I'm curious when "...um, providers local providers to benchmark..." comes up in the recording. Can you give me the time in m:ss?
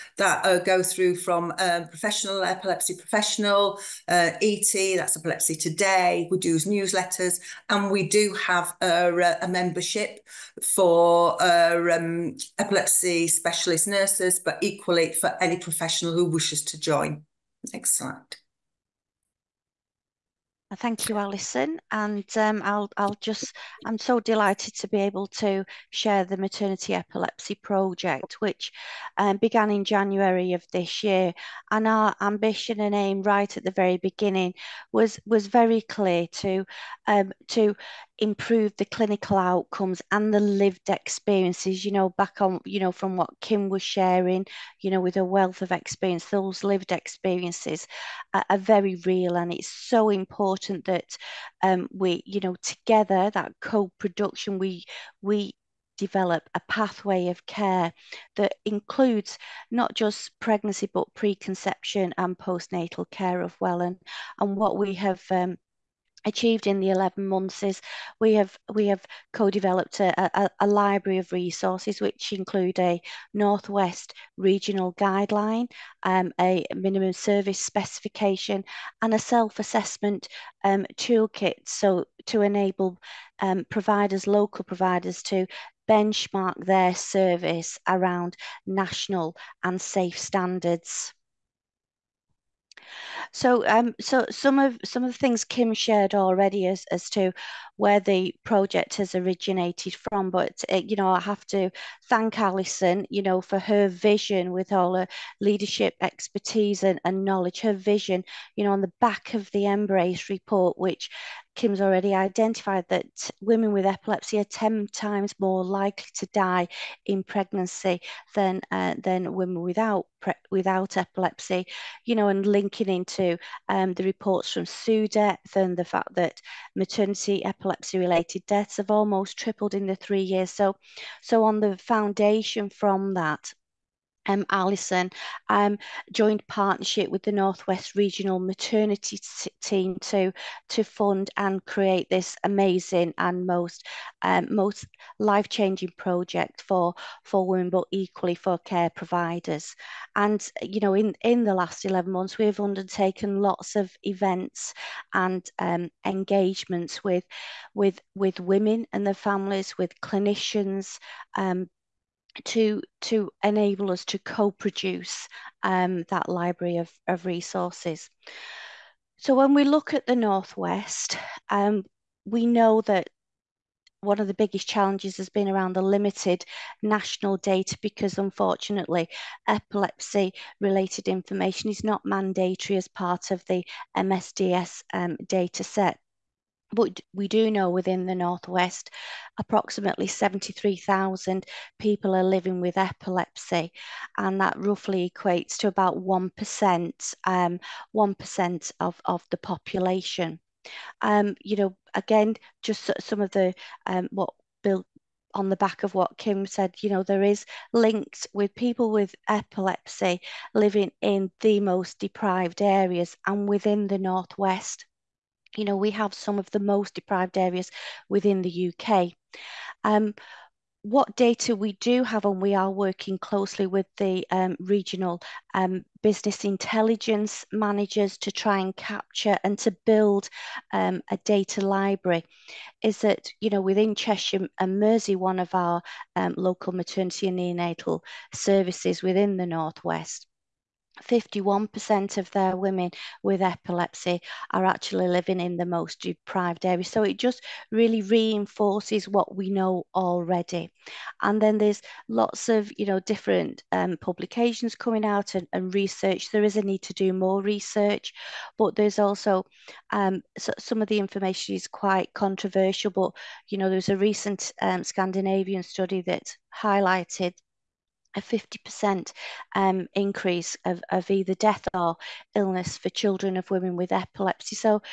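1:23.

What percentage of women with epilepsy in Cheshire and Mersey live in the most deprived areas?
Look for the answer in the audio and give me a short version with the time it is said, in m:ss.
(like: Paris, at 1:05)
51%, at 4:01.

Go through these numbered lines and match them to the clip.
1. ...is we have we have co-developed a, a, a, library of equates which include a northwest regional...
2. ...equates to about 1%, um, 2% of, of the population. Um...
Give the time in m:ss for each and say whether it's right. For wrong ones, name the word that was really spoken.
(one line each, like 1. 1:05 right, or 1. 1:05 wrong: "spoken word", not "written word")
1. 1:07 wrong: "resources", not "equates"
2. 3:15 wrong: "1", not "2".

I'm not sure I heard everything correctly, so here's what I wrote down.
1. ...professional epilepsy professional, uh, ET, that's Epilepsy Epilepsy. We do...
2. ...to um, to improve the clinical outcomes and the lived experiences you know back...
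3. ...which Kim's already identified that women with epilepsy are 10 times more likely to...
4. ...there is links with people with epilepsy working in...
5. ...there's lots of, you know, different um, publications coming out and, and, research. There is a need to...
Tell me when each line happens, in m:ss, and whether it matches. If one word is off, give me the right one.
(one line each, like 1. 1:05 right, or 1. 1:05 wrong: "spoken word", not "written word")
1. 0:01 wrong: "Today", not "Epilepsy"
2. 0:36 right
3. 1:50 right
4. 3:27 wrong: "living", not "working"
5. 4:11 right.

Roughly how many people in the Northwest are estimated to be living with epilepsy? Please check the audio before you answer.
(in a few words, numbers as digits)
73,000.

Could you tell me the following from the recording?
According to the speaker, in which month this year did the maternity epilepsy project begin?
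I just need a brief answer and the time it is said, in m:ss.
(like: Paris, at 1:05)
January, at 0:29.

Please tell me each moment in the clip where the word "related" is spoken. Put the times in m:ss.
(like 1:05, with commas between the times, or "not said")
2:07, 3:00.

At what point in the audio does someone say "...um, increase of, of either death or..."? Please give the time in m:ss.
4:29.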